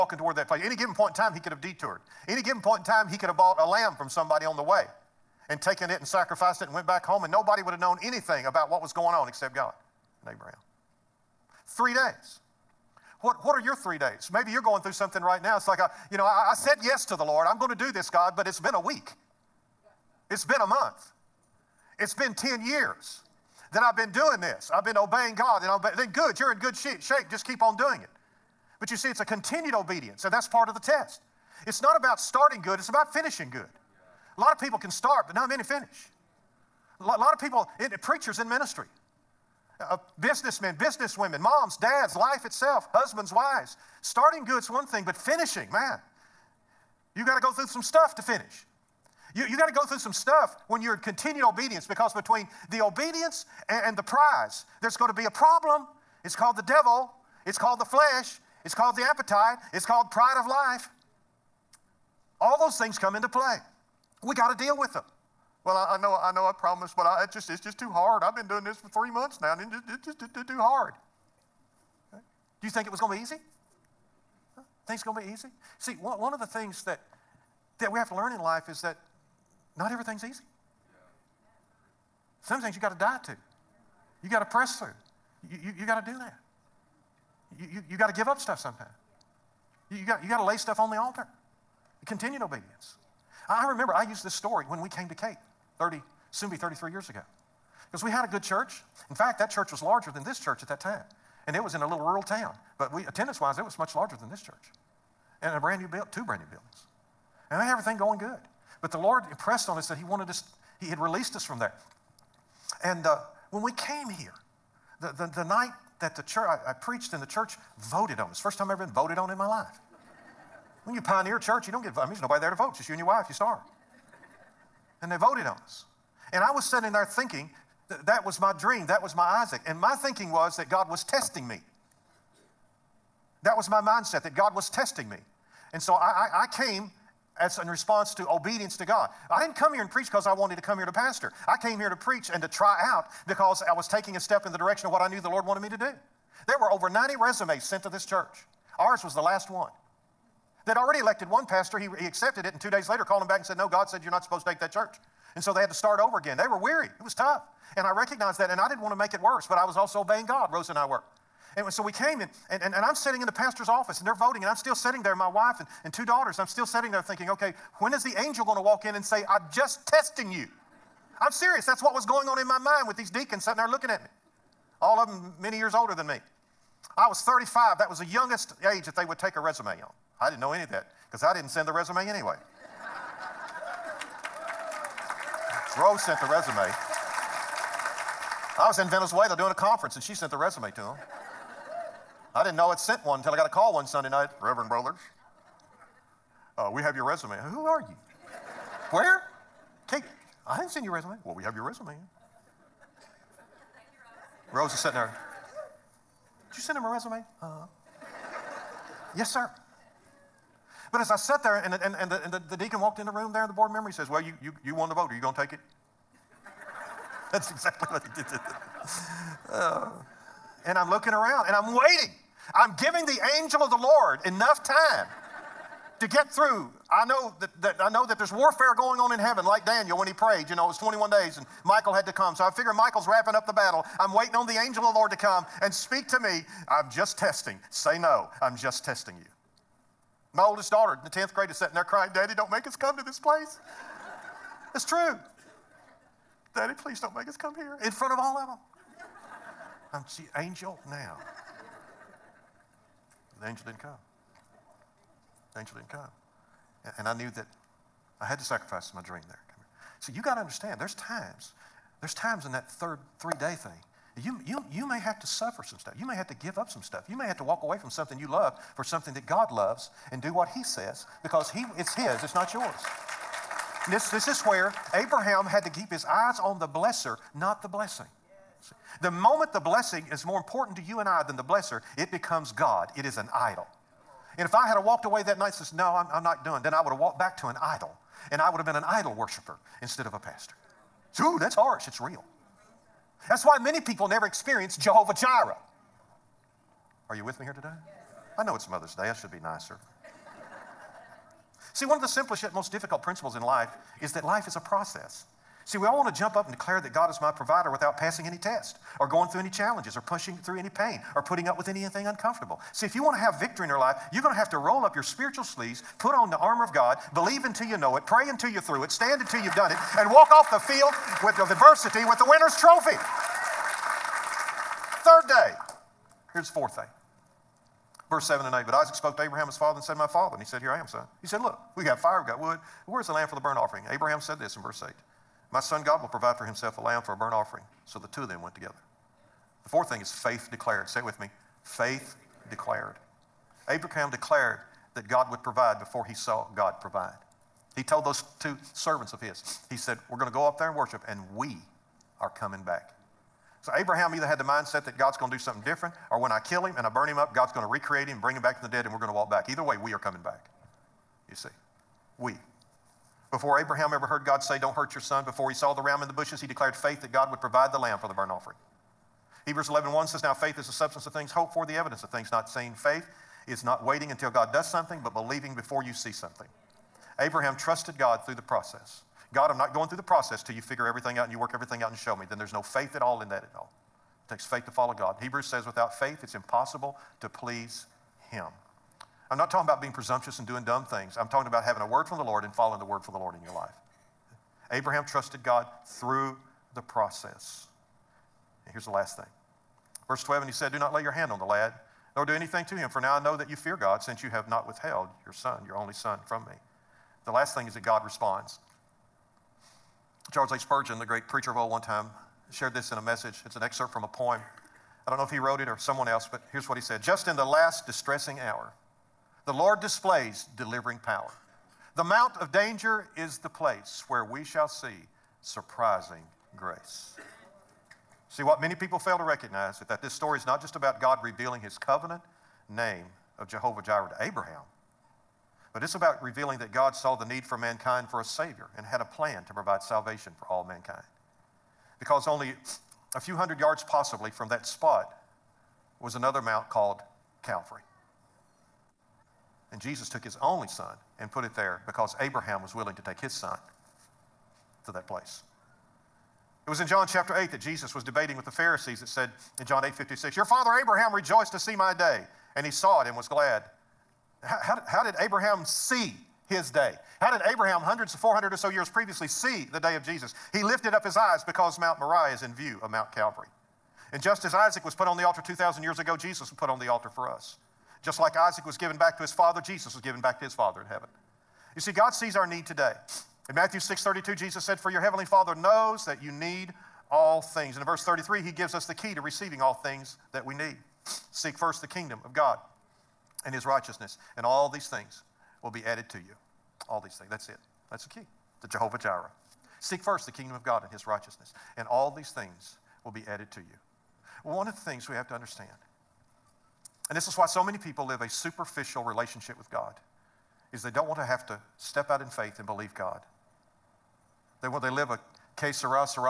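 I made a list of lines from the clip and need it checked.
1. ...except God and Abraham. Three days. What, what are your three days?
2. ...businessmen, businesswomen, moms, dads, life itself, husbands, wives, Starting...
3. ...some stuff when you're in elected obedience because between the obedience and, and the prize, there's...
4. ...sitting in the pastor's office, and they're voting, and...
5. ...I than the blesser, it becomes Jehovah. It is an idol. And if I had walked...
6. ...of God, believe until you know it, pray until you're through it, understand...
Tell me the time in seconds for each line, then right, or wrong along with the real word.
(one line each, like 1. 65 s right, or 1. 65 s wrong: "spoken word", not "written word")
1. 9 s right
2. 40 s right
3. 49 s wrong: "continued", not "elected"
4. 162 s right
5. 281 s wrong: "God", not "Jehovah"
6. 316 s wrong: "stand", not "understand".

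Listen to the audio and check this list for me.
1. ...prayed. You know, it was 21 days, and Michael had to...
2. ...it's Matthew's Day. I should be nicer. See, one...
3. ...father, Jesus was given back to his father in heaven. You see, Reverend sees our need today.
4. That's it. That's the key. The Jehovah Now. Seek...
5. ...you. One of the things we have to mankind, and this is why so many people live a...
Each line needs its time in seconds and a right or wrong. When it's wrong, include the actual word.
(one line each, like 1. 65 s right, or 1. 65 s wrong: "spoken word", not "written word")
1. 230 s right
2. 298 s wrong: "Mother", not "Matthew"
3. 479 s wrong: "God", not "Reverend"
4. 497 s wrong: "Jireh", not "Now"
5. 503 s wrong: "understand", not "mankind".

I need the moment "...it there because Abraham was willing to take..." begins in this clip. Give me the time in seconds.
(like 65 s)
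451 s.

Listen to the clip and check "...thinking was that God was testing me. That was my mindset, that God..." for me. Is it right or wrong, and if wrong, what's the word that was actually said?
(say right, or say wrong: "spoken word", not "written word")
right.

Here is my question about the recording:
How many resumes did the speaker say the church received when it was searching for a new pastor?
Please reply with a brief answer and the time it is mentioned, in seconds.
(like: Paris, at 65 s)
over 90, at 146 s.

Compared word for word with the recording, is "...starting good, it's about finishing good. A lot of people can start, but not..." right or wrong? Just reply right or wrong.
right.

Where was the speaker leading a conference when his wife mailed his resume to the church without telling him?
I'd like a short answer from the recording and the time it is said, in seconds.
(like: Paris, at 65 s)
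Venezuela, at 188 s.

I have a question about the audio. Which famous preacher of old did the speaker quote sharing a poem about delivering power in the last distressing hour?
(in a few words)
Charles H. Spurgeon.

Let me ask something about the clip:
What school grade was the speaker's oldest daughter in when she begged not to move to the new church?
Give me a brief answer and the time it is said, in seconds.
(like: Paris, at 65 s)
10th grade, at 241 s.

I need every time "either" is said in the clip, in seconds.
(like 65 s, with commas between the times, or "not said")
354 s, 359 s.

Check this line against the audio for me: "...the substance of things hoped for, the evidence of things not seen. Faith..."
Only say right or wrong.
right.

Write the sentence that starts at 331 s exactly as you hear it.
He said, Look, we got fire, we got wood.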